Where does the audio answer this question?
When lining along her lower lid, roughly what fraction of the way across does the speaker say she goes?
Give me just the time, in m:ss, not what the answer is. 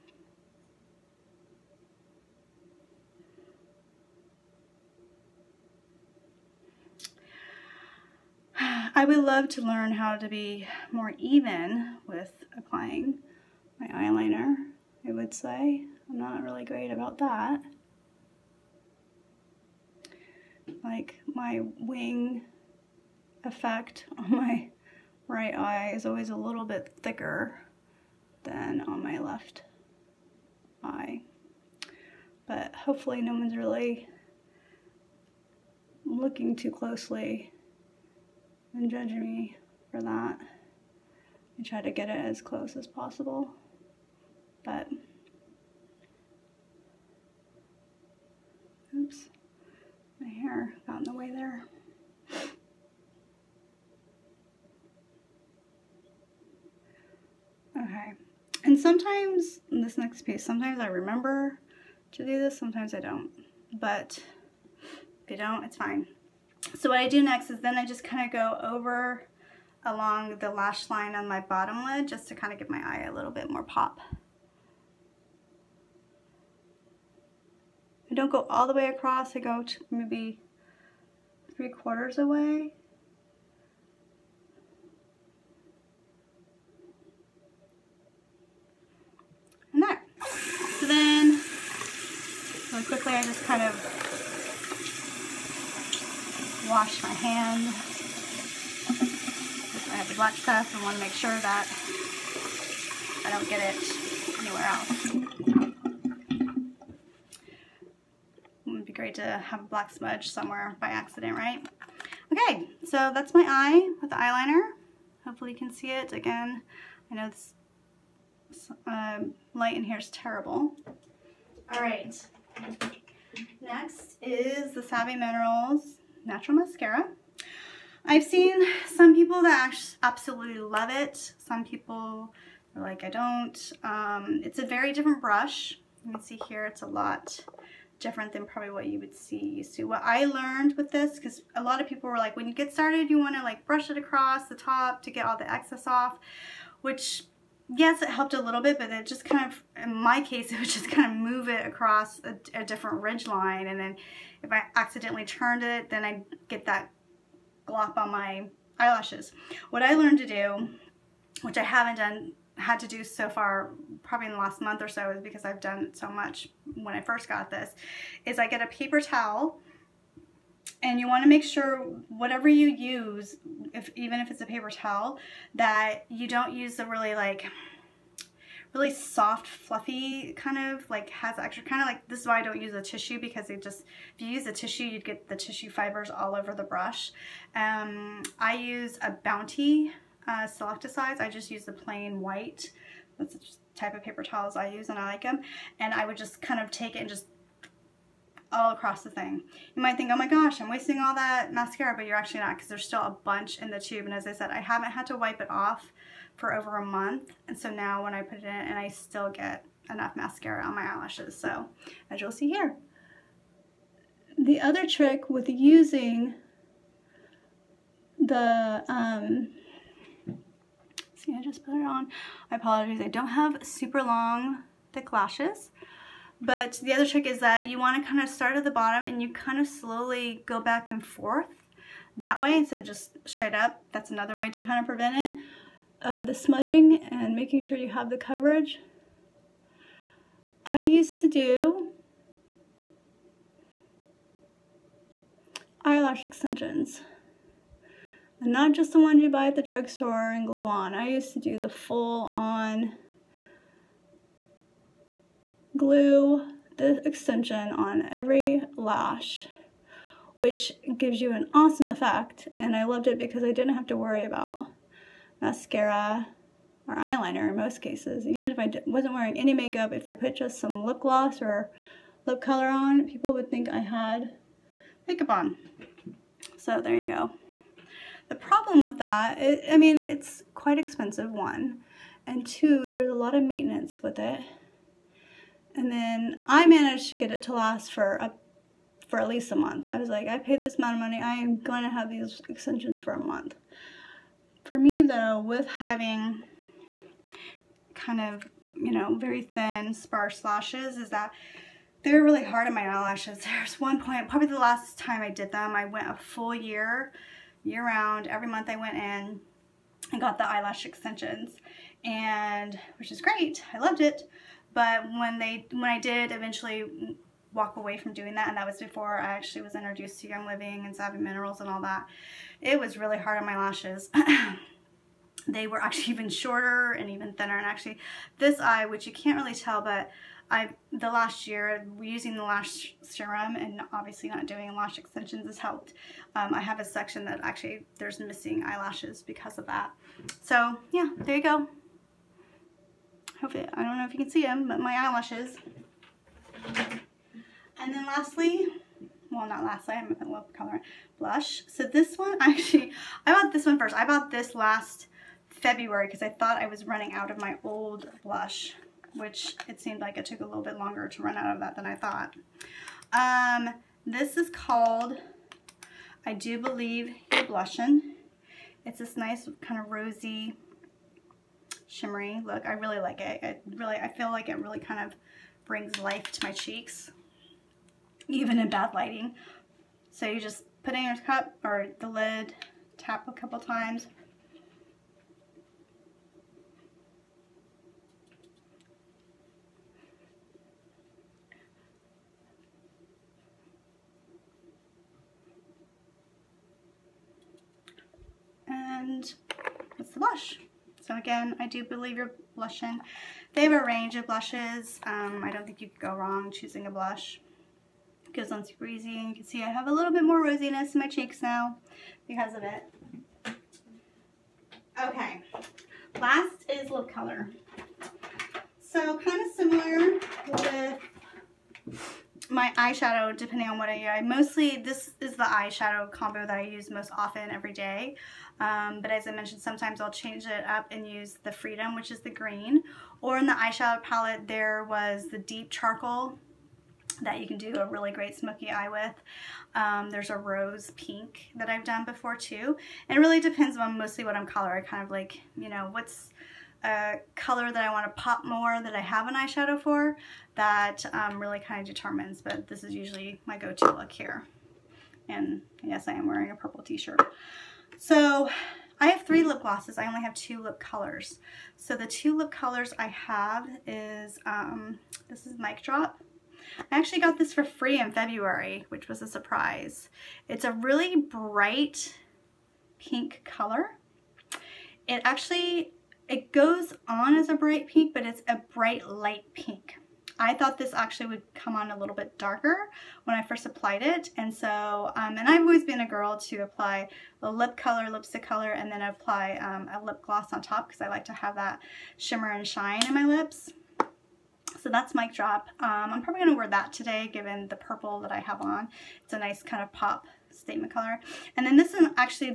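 1:21.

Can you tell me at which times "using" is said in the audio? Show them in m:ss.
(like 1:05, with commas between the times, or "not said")
3:35, 5:32.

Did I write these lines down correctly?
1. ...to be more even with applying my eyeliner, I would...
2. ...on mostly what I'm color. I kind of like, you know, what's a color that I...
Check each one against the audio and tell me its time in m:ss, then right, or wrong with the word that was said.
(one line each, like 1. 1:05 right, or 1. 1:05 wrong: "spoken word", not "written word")
1. 0:10 right
2. 7:23 right.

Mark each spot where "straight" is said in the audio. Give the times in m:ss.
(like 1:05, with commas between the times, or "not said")
3:53.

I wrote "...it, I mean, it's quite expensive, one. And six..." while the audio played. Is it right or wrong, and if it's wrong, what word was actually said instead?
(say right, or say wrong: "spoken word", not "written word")
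wrong: "two", not "six".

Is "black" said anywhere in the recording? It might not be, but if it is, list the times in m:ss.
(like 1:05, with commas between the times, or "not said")
1:40, 1:49.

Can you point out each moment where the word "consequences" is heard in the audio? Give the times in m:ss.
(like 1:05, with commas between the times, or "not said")
not said.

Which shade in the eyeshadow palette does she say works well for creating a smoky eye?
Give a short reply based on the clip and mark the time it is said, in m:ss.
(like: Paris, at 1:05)
Deep Charcoal, at 7:15.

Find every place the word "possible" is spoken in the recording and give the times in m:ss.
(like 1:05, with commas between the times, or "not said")
0:42.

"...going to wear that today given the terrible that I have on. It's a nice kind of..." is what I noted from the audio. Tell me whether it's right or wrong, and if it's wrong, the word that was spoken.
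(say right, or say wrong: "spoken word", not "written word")
wrong: "purple", not "terrible".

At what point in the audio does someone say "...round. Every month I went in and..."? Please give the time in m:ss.
5:07.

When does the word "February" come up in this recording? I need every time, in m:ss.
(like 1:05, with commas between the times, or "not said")
5:55, 7:48.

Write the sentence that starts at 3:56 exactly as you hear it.
Uh, the smudging and making sure you have the coverage.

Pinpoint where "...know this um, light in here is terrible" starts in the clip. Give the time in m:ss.
1:57.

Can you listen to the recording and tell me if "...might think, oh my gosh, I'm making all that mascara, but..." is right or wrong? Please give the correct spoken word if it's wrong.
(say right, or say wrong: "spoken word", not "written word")
wrong: "wasting", not "making".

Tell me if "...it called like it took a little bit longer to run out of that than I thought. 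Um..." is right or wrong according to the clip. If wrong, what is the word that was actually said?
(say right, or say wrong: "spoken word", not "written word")
wrong: "seemed", not "called".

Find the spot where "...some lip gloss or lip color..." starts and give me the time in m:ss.
4:30.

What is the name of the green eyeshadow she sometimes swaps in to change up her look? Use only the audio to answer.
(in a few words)
Freedom.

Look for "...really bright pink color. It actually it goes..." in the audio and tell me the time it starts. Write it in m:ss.
7:50.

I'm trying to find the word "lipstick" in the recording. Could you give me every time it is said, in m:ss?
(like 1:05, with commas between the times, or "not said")
8:08.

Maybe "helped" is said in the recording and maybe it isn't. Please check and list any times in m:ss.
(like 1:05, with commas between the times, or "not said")
2:28, 5:35.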